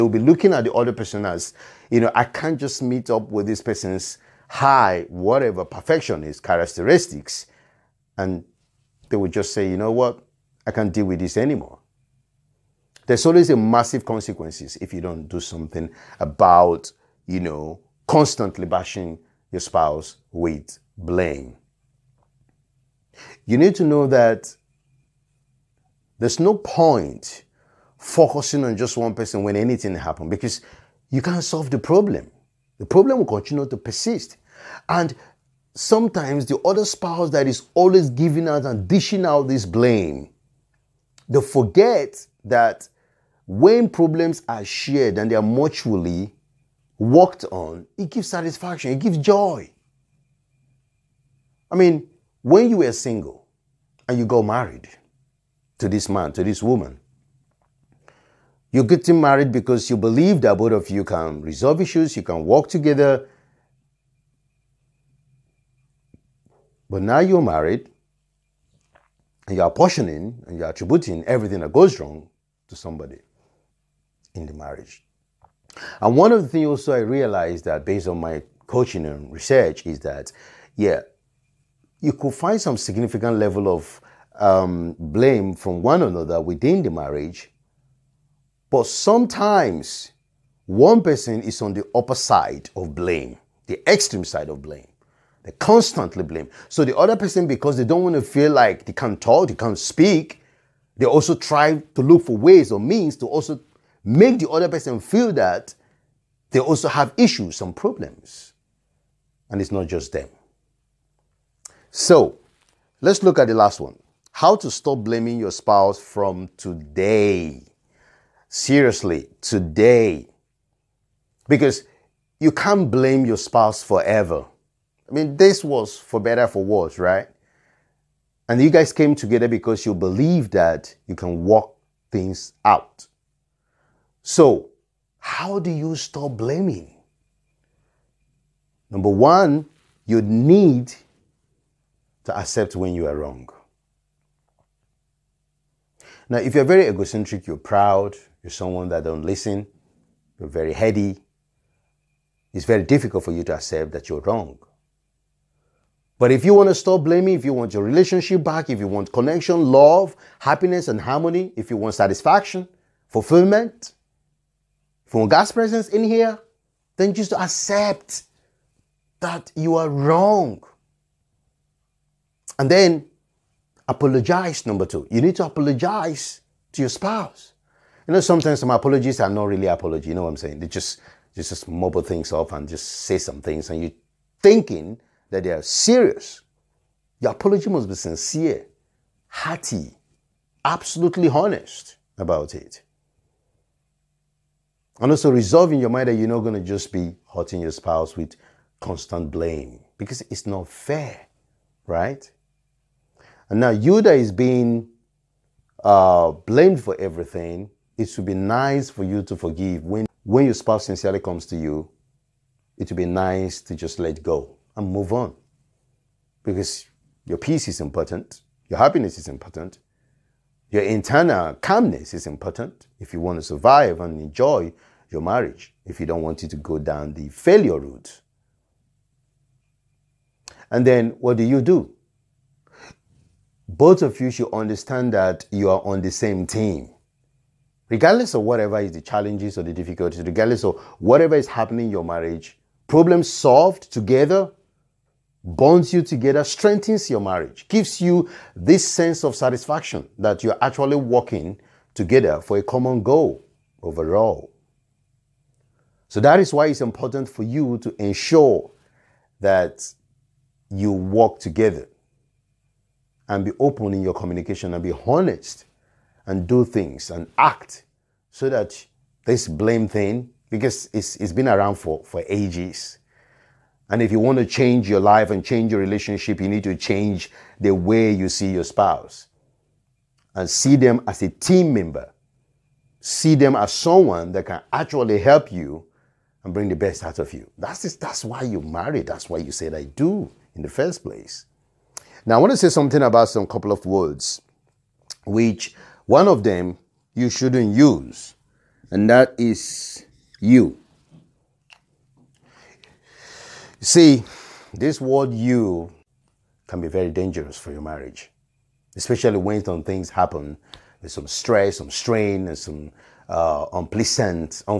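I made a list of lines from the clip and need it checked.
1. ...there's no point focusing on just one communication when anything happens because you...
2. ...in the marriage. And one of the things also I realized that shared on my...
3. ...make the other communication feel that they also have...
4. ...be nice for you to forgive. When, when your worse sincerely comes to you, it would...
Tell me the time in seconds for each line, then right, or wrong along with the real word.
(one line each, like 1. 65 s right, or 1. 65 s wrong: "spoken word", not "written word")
1. 26 s wrong: "person", not "communication"
2. 74 s wrong: "based", not "shared"
3. 104 s wrong: "person", not "communication"
4. 208 s wrong: "spouse", not "worse".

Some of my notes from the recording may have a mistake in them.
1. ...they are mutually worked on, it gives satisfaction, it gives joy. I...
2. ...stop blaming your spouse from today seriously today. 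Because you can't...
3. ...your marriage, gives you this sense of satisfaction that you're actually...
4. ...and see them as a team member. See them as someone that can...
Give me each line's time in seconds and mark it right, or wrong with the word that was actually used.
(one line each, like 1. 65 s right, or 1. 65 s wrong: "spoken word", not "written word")
1. 45 s right
2. 114 s right
3. 247 s right
4. 280 s right.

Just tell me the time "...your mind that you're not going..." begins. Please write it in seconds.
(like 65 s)
195 s.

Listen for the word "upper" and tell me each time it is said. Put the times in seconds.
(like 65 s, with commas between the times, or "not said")
91 s.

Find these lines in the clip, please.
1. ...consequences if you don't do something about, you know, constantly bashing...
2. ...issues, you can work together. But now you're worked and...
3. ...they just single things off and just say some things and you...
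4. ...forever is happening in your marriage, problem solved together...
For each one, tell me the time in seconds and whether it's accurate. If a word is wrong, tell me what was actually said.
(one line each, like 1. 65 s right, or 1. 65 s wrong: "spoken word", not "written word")
1. 14 s right
2. 61 s wrong: "married", not "worked"
3. 181 s wrong: "mumble", not "single"
4. 240 s wrong: "whatever", not "forever".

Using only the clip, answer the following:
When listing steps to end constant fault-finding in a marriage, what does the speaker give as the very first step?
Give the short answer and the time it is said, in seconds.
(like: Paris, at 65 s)
Accept when you are wrong, at 142 s.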